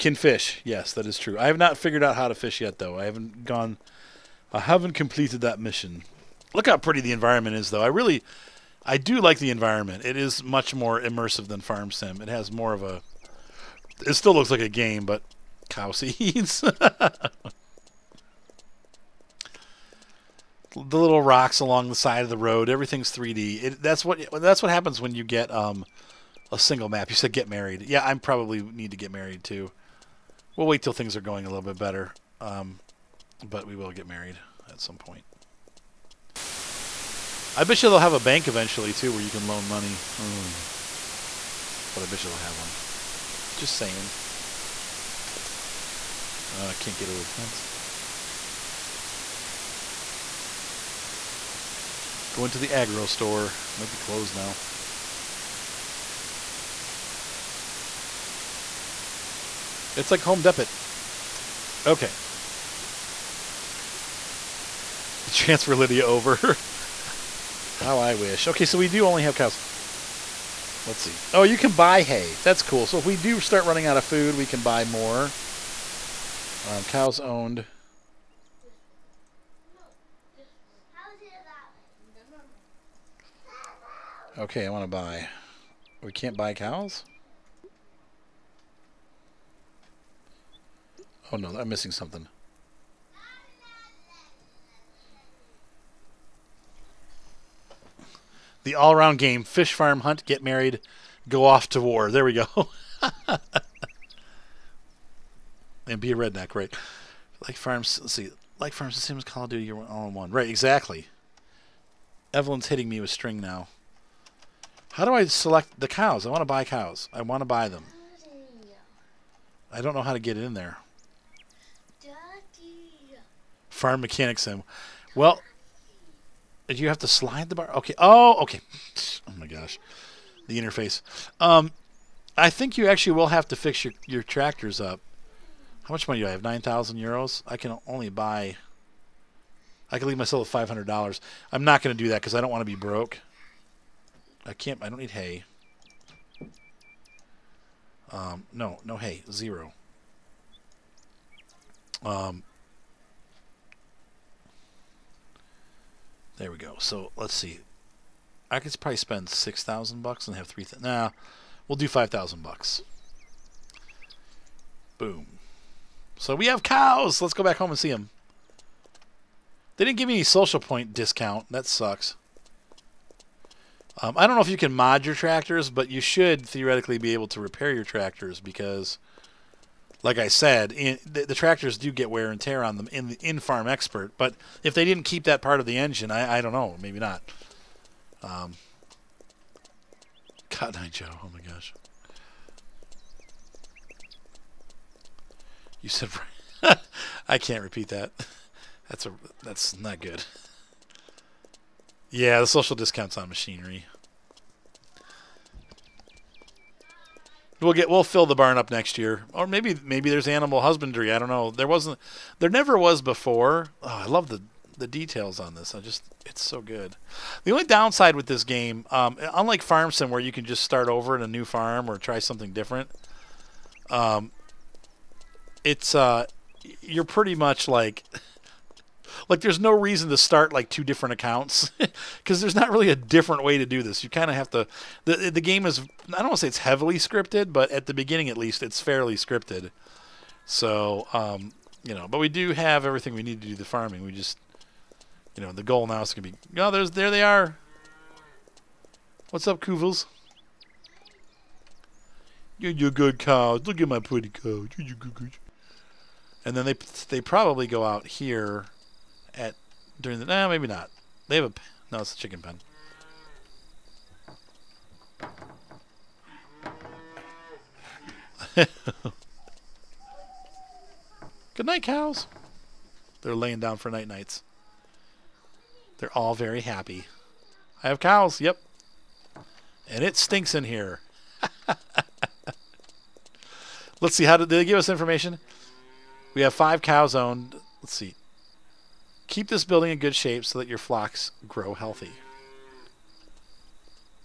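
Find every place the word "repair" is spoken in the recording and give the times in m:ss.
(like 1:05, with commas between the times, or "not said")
2:57.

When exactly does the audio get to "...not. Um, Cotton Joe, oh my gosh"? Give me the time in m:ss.
3:06.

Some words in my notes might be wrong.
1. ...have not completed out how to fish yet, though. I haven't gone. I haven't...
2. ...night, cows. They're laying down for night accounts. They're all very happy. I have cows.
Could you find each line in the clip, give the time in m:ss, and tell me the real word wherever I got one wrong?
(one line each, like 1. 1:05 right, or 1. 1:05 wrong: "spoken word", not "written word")
1. 0:01 wrong: "figured", not "completed"
2. 4:31 wrong: "nights", not "accounts".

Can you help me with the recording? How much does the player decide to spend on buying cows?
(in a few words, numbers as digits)
5000 bucks.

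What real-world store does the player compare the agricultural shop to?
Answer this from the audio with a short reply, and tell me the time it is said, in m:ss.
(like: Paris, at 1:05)
Home Depot, at 1:00.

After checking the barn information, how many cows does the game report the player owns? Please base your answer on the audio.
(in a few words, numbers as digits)
5.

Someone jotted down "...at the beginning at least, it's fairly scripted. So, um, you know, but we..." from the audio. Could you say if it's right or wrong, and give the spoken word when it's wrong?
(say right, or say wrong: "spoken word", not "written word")
right.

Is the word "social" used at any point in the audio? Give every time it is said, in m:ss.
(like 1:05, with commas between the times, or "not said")
2:50, 3:22.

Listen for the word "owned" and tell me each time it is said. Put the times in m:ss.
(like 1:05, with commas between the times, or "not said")
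1:17, 4:47.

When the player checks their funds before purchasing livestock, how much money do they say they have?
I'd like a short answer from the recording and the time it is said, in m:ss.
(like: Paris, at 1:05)
9000 euros, at 2:16.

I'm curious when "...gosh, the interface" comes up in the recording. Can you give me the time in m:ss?
2:09.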